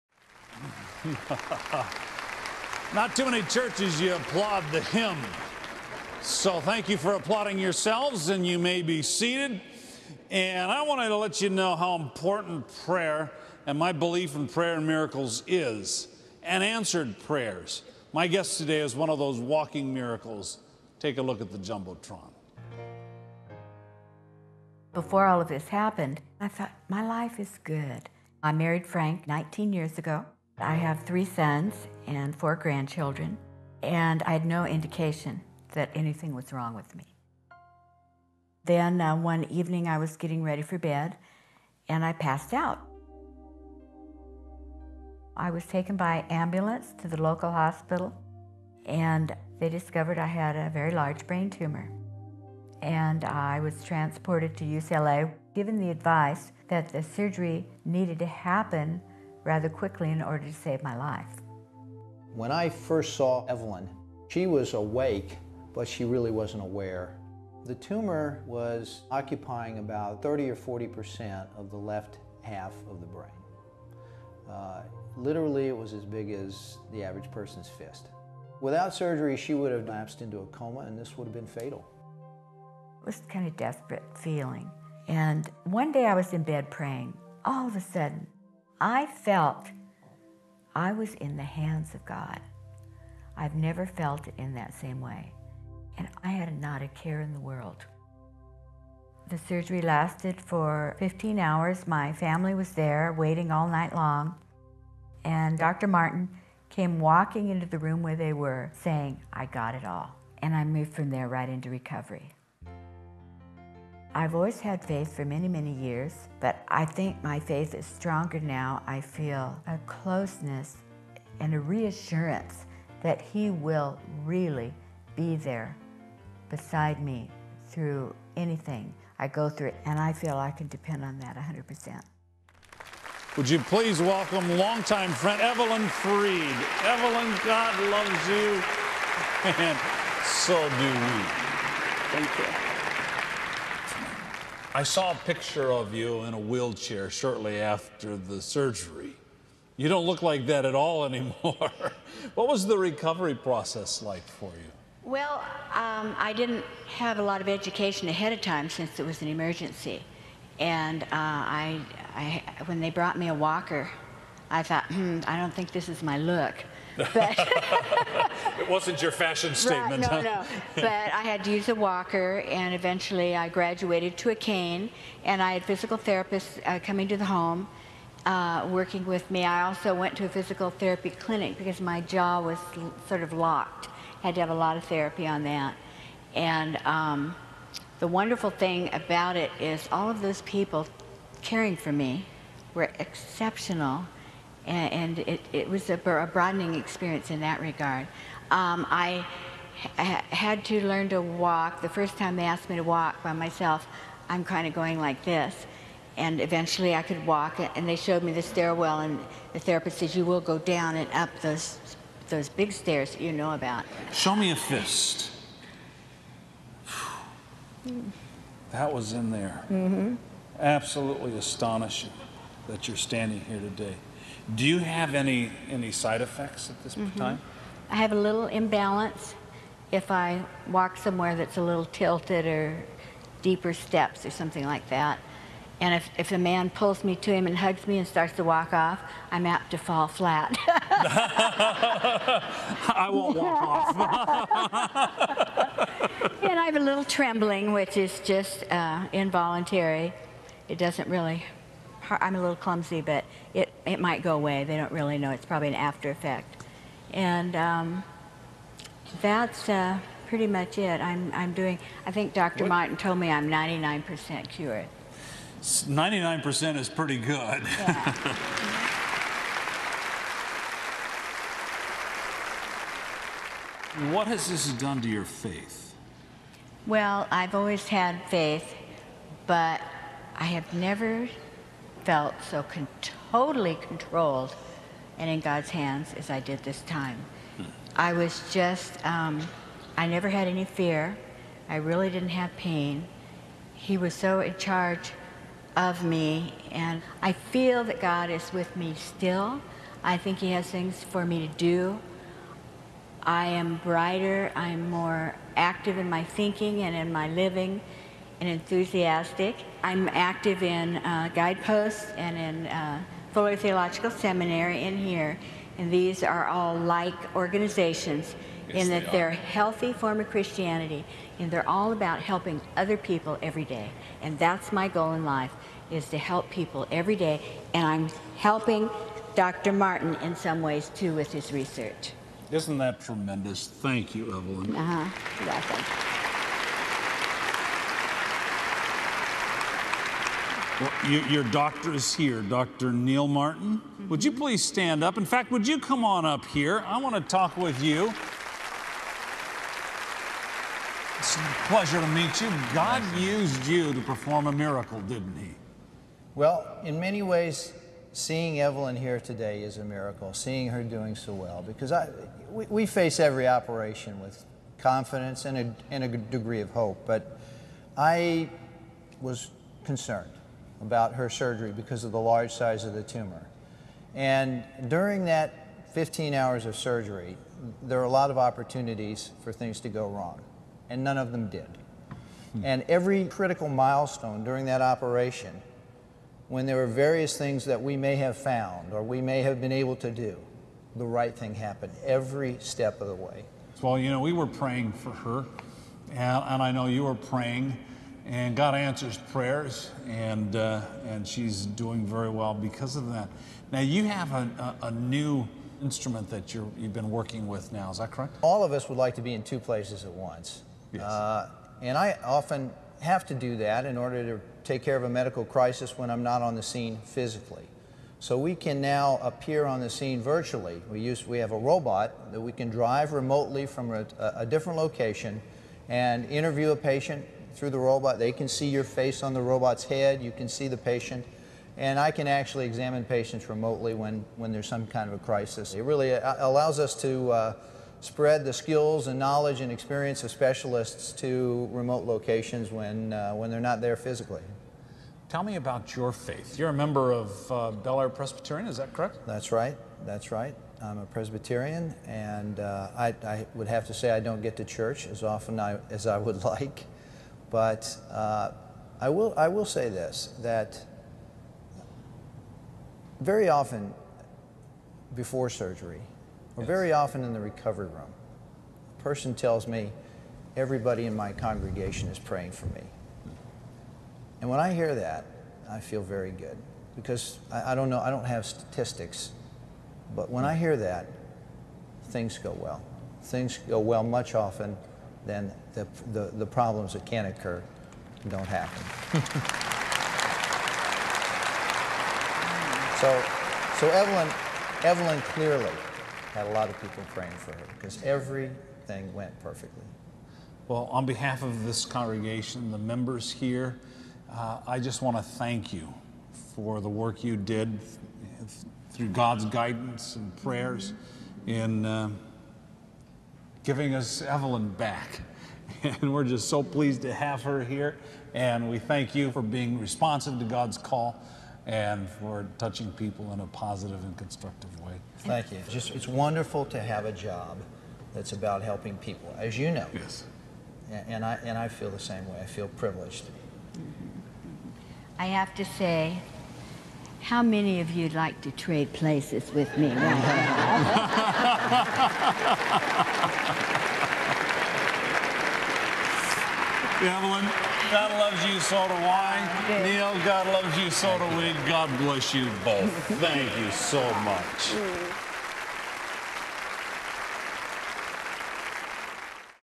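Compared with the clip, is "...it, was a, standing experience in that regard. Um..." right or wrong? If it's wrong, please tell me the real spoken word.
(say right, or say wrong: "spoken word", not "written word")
wrong: "broadening", not "standing".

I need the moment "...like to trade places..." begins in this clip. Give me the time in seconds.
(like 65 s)
538 s.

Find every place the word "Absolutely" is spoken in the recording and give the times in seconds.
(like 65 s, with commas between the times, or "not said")
220 s.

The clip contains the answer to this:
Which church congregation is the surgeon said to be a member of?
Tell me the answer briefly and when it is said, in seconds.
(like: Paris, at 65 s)
Bel Air Presbyterian, at 447 s.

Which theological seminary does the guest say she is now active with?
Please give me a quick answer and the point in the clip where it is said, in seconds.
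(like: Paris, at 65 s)
Fuller Theological Seminary, at 313 s.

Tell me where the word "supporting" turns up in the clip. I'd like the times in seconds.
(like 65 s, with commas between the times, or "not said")
not said.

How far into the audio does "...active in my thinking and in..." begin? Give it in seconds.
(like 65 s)
305 s.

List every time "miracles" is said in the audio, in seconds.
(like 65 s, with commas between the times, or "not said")
14 s, 19 s, 354 s, 359 s.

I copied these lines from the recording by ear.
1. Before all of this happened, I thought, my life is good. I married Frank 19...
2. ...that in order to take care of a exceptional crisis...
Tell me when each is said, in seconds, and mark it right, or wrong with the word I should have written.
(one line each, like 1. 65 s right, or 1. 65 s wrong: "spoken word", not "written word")
1. 24 s right
2. 413 s wrong: "medical", not "exceptional".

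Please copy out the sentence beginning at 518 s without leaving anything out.
And we thank you for being responsive to God's call and for touching people in a positive and constructive way.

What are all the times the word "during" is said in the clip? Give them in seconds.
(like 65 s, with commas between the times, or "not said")
374 s, 384 s.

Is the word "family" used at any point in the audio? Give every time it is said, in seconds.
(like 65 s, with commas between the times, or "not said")
102 s.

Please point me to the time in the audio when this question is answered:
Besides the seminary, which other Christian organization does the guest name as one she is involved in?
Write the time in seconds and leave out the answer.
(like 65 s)
311 s.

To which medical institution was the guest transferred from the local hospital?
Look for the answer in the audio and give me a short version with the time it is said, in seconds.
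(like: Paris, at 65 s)
UCLA, at 54 s.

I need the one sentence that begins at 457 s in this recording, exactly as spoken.
But uh, I, will, I will say this that very often before surgery, or yes.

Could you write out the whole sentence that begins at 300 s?
I think He has things for me to do.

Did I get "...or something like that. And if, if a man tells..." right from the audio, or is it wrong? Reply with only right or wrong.
wrong.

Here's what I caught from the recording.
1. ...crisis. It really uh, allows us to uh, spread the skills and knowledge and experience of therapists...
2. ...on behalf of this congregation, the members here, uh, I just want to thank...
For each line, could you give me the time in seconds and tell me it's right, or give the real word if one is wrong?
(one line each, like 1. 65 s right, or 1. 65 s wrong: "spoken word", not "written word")
1. 435 s wrong: "specialists", not "therapists"
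2. 500 s right.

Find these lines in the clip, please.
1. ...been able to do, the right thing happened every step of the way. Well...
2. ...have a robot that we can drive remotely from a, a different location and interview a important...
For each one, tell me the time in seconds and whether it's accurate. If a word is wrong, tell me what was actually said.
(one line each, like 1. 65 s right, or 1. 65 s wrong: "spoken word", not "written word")
1. 389 s right
2. 421 s wrong: "patient", not "important".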